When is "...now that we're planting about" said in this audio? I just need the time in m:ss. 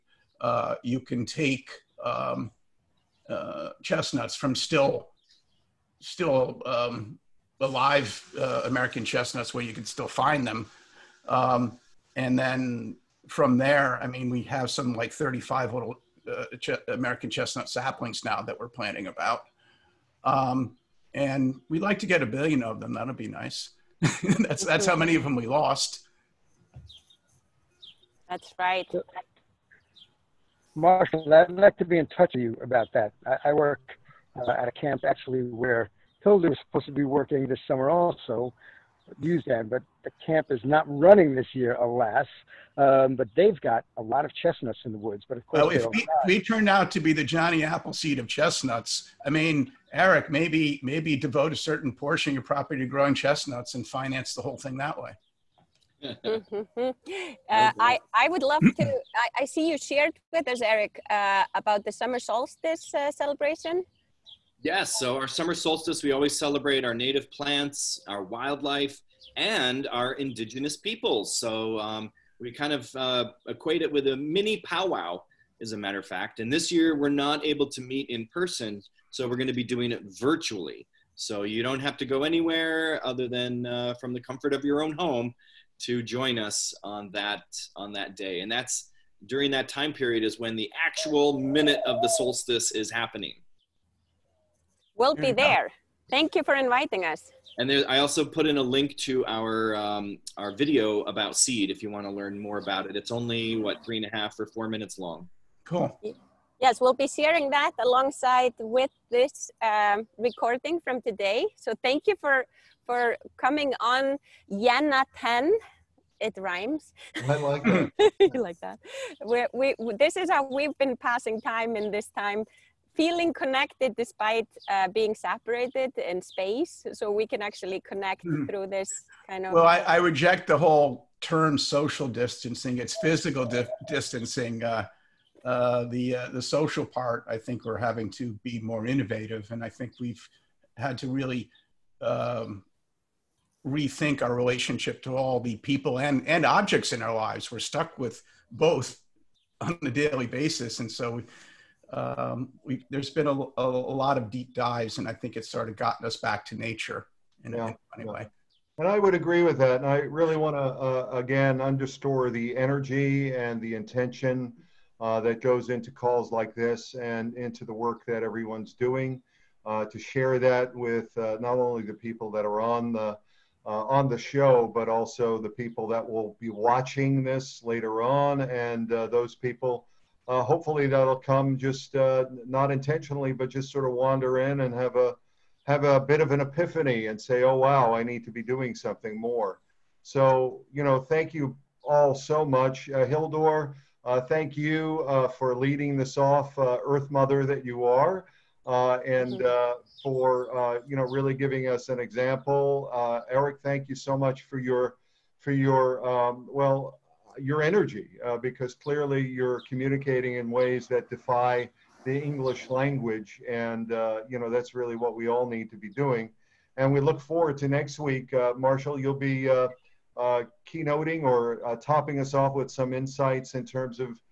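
0:18.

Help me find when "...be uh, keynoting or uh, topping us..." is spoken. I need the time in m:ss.
3:39.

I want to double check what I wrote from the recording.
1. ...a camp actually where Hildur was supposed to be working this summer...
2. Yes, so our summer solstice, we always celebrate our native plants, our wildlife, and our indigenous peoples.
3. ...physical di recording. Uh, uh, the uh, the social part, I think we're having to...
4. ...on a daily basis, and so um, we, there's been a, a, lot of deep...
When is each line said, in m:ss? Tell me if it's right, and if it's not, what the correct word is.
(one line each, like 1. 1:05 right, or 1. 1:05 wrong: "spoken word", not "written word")
1. 0:34 right
2. 1:04 right
3. 2:12 wrong: "distancing", not "recording"
4. 2:29 right.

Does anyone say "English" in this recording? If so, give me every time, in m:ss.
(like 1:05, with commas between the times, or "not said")
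3:32.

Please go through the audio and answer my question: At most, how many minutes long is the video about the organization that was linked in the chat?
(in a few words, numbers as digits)
4 minutes.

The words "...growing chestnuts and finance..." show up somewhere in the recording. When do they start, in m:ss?
0:52.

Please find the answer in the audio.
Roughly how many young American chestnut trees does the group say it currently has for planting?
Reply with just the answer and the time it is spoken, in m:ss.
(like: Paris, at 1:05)
35, at 0:15.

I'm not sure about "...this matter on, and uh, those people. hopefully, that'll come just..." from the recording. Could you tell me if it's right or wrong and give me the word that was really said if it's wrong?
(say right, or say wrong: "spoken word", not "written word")
wrong: "later", not "matter".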